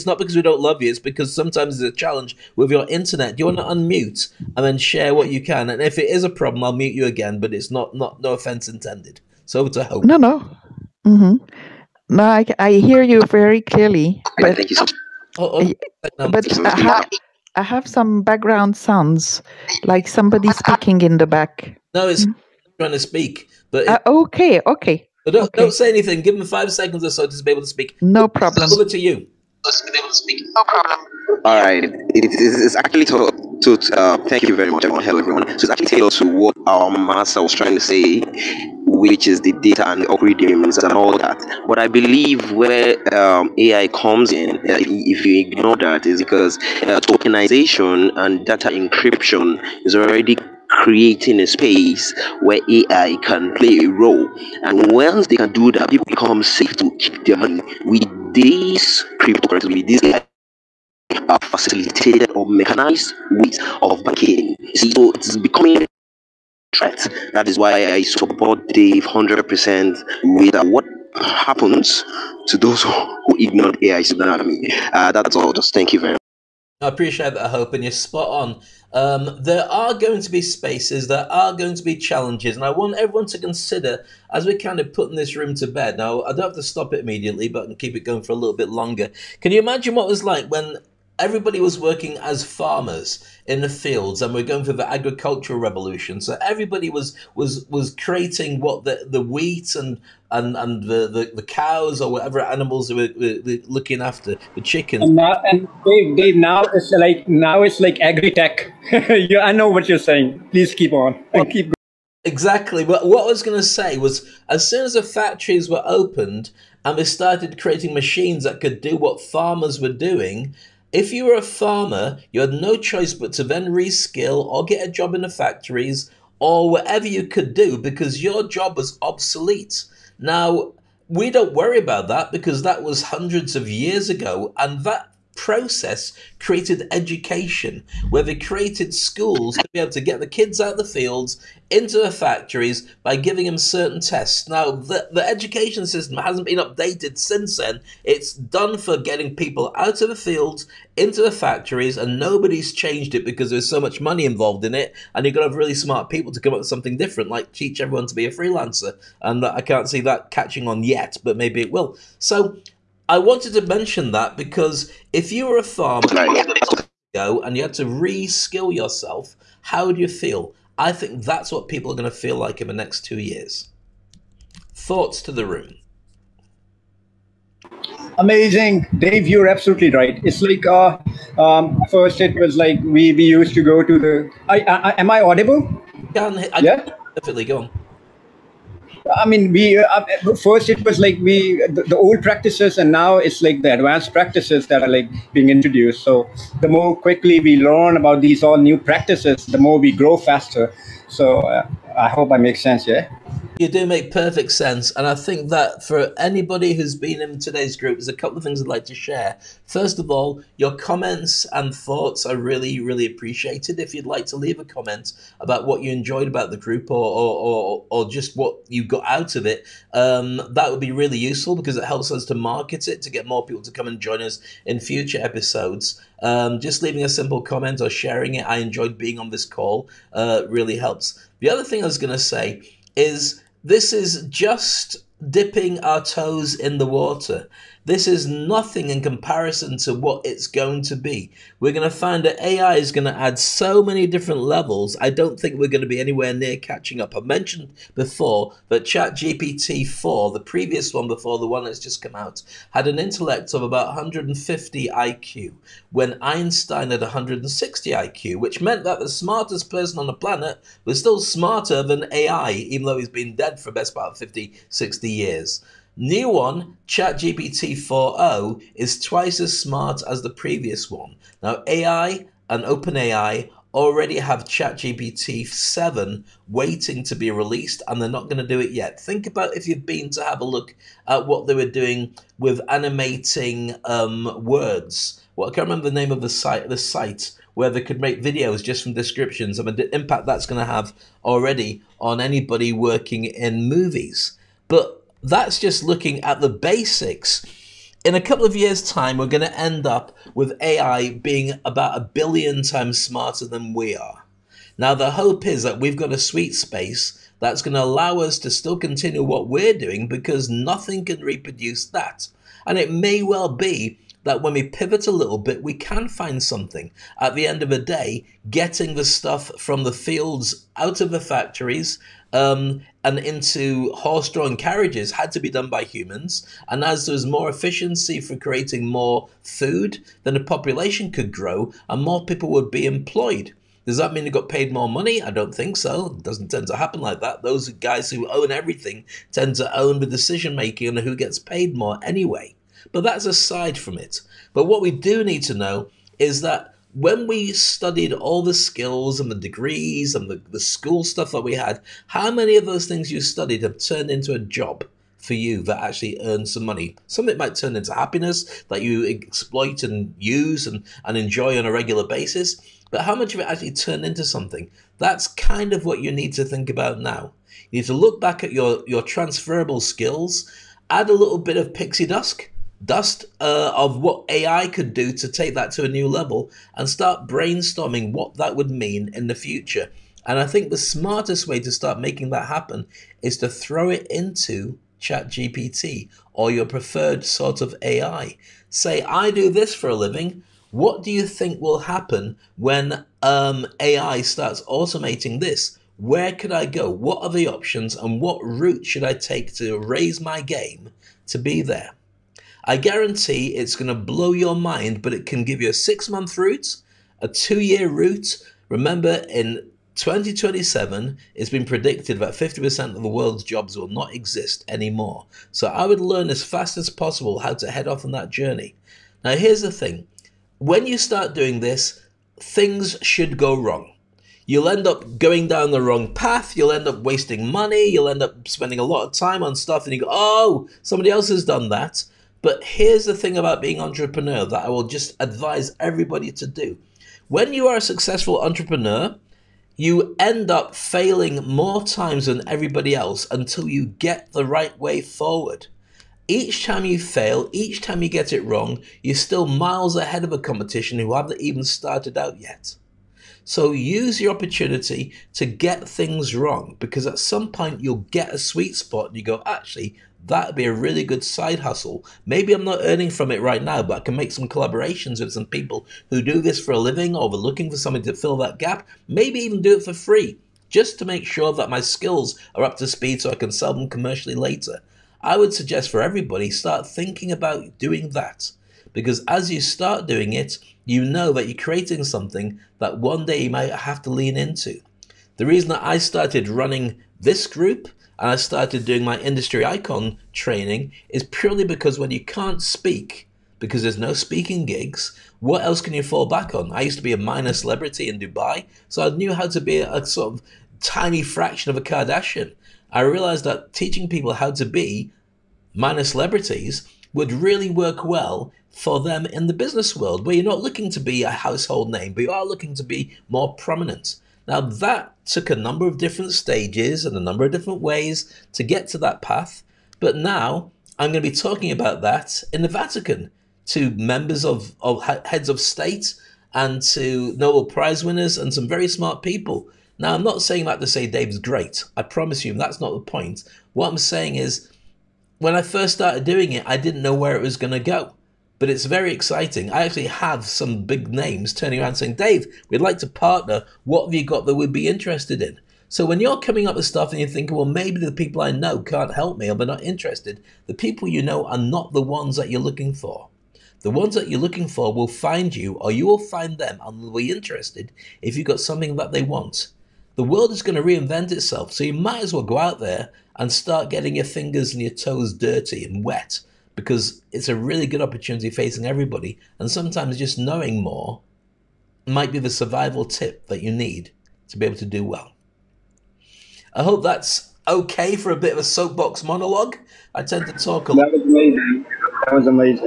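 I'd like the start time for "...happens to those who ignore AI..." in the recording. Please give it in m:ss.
1:11.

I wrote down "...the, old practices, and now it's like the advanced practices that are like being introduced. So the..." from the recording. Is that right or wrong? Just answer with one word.
right.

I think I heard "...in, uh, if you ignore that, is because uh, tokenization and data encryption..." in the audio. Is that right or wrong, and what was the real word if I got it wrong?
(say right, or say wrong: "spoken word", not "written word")
right.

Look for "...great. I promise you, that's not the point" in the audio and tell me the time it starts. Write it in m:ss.
8:51.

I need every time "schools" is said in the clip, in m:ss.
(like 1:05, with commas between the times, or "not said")
2:18, 5:50.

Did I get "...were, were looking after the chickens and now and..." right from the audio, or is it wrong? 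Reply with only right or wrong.
right.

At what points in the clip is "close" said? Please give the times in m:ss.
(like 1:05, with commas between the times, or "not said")
not said.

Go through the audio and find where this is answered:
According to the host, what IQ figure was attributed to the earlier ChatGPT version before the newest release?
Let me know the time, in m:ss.
4:13.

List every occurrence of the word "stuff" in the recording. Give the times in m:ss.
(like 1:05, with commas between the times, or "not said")
5:19, 5:51, 7:09, 9:06.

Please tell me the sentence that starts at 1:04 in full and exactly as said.
See, so it's becoming a threat.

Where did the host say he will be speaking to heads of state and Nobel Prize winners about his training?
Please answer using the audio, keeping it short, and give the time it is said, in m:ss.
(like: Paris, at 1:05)
the Vatican, at 8:42.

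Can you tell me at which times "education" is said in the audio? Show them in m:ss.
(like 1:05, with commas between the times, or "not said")
2:16, 2:25.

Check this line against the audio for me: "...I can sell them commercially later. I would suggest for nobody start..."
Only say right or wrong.
wrong.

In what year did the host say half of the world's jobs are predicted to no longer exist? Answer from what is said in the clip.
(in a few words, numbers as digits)
2027.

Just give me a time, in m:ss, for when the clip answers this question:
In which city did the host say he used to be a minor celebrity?
8:18.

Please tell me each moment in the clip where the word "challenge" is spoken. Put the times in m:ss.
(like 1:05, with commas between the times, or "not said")
0:01, 1:21.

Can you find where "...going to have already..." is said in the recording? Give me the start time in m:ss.
4:50.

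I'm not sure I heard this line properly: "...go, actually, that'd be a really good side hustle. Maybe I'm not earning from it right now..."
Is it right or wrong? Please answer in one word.
right.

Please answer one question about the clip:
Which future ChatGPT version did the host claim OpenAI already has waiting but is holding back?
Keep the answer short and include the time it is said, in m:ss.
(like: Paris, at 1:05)
ChatGPT 7, at 4:34.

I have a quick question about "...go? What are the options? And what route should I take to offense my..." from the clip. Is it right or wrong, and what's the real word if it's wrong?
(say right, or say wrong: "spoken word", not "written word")
wrong: "raise", not "offense".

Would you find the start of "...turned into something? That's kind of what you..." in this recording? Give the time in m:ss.
6:03.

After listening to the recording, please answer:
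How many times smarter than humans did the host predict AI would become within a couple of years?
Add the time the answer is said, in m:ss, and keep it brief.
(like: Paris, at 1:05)
a billion times, at 5:01.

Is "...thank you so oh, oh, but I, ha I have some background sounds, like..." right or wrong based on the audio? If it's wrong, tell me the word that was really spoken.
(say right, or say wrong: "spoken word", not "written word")
right.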